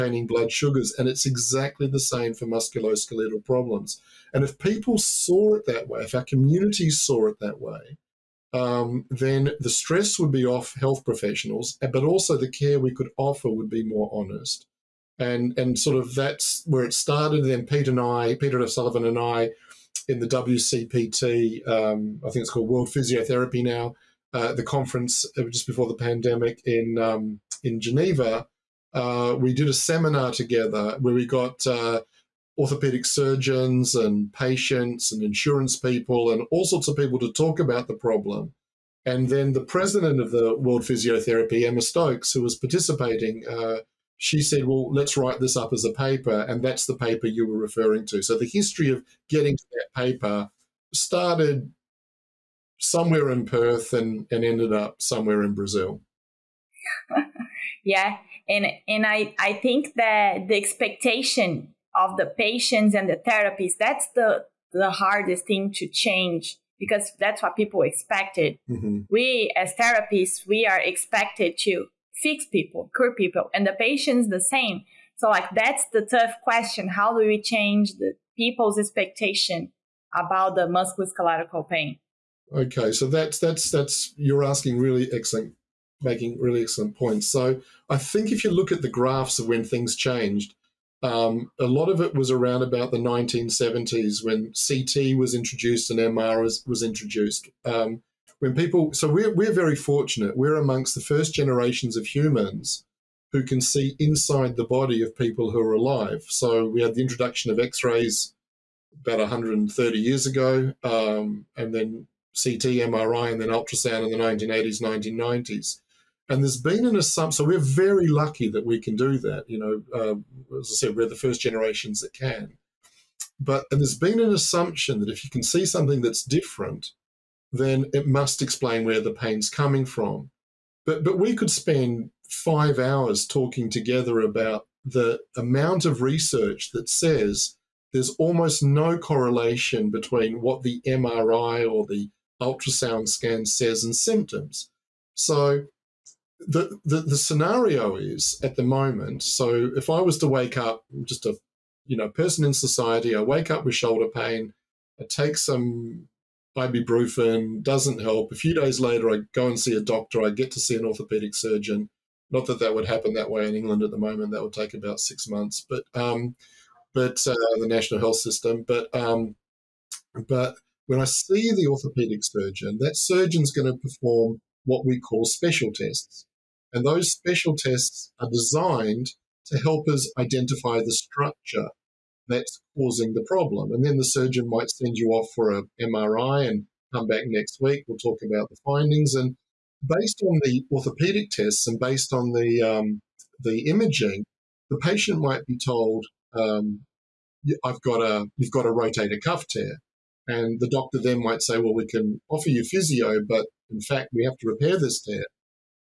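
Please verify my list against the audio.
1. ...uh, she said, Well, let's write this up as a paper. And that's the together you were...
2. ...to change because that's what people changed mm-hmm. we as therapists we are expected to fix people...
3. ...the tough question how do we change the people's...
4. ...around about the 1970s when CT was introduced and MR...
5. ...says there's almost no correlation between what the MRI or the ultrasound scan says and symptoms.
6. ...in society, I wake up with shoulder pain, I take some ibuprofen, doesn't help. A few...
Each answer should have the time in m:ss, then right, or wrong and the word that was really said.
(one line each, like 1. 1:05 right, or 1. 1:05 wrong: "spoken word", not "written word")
1. 0:43 wrong: "paper", not "together"
2. 1:05 wrong: "expected", not "changed"
3. 1:15 right
4. 1:32 right
5. 2:16 right
6. 2:32 right.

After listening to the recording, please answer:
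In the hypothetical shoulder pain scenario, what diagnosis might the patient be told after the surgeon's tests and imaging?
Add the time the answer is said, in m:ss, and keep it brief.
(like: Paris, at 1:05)
rotator cuff tear, at 3:18.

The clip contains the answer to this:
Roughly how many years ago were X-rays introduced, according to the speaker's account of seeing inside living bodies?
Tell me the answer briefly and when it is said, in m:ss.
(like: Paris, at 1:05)
130 years, at 1:49.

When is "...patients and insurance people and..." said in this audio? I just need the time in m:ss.
0:34.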